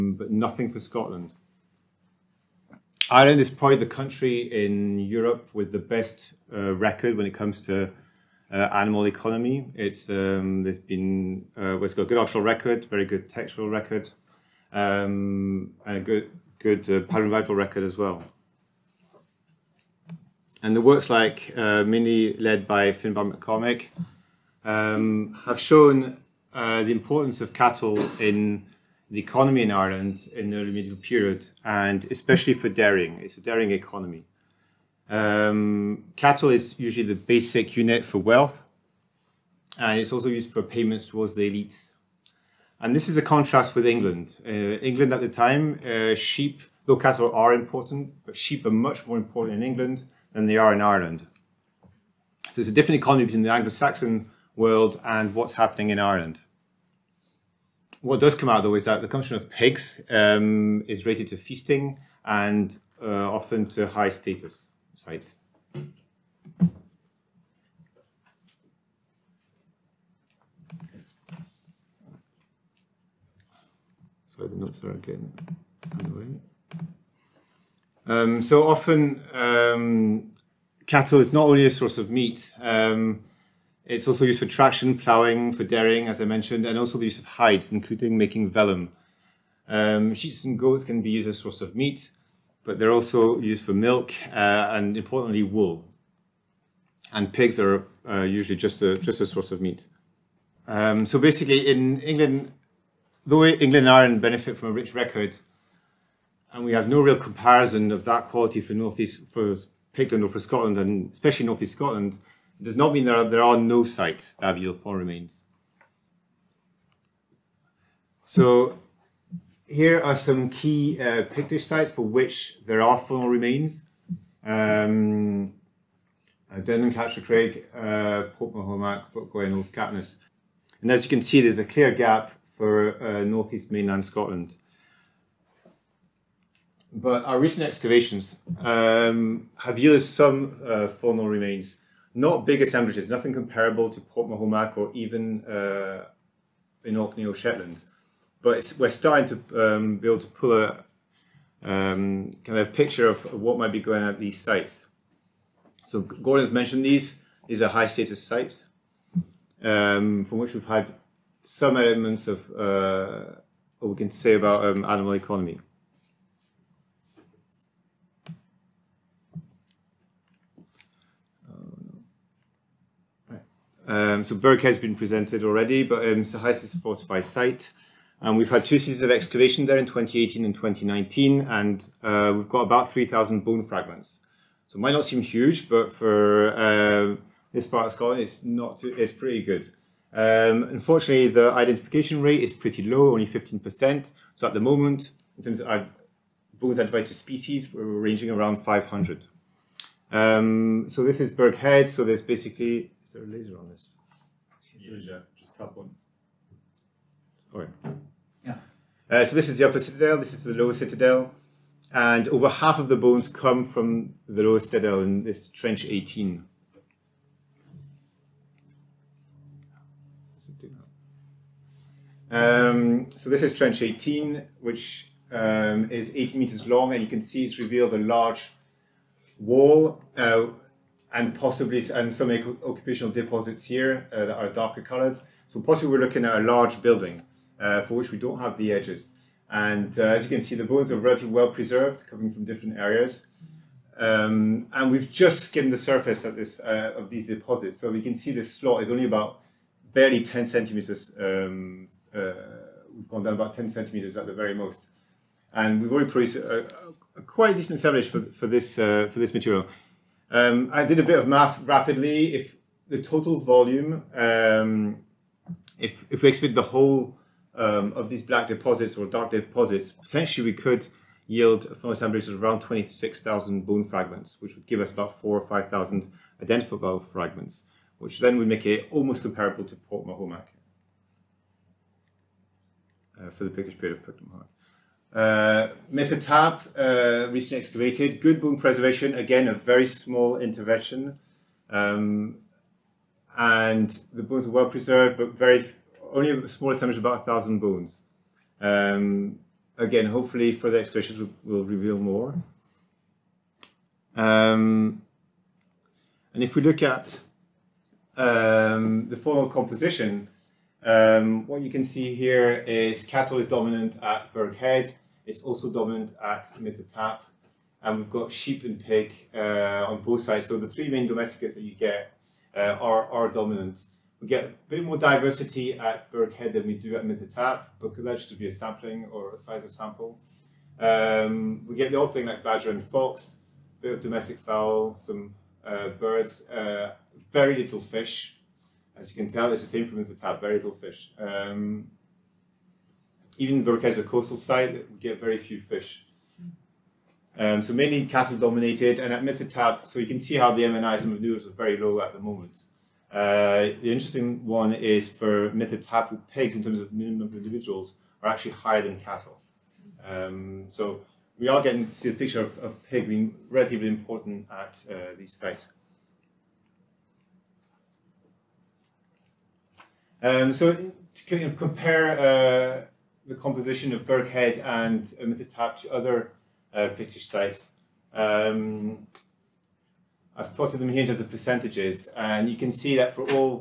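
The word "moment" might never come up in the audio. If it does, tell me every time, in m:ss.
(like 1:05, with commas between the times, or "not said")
3:14, 5:52.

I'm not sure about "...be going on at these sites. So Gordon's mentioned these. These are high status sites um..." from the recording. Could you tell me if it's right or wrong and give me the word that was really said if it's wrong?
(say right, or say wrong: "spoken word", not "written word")
right.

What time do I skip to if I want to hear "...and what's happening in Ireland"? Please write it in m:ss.
0:55.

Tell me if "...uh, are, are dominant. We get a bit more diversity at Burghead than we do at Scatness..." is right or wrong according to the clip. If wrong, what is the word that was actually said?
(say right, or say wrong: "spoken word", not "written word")
wrong: "Mither", not "Scatness".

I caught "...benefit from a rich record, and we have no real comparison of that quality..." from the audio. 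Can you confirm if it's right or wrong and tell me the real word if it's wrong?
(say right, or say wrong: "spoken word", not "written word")
right.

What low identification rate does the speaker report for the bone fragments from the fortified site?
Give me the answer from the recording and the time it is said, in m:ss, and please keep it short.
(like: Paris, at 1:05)
15%, at 3:13.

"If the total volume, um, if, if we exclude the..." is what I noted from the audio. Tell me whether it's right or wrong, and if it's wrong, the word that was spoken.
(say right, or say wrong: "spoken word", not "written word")
right.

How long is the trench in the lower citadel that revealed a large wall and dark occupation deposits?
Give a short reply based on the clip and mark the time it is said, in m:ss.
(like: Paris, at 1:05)
18 meters, at 3:46.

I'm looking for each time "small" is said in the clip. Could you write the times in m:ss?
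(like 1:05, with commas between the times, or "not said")
4:49, 4:56.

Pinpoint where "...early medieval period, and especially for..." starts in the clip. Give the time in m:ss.
0:30.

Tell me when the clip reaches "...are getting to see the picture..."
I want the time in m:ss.
6:01.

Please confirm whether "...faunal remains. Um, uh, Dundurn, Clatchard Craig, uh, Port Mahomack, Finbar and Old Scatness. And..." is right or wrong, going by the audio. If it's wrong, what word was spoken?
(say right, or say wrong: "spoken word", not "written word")
wrong: "Buckquoy", not "Finbar".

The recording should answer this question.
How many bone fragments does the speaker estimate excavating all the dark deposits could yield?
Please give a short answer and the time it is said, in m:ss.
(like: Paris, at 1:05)
26,000, at 4:32.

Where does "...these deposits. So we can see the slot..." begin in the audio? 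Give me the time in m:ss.
4:07.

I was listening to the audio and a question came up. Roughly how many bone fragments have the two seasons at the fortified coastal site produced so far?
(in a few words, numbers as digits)
3,000.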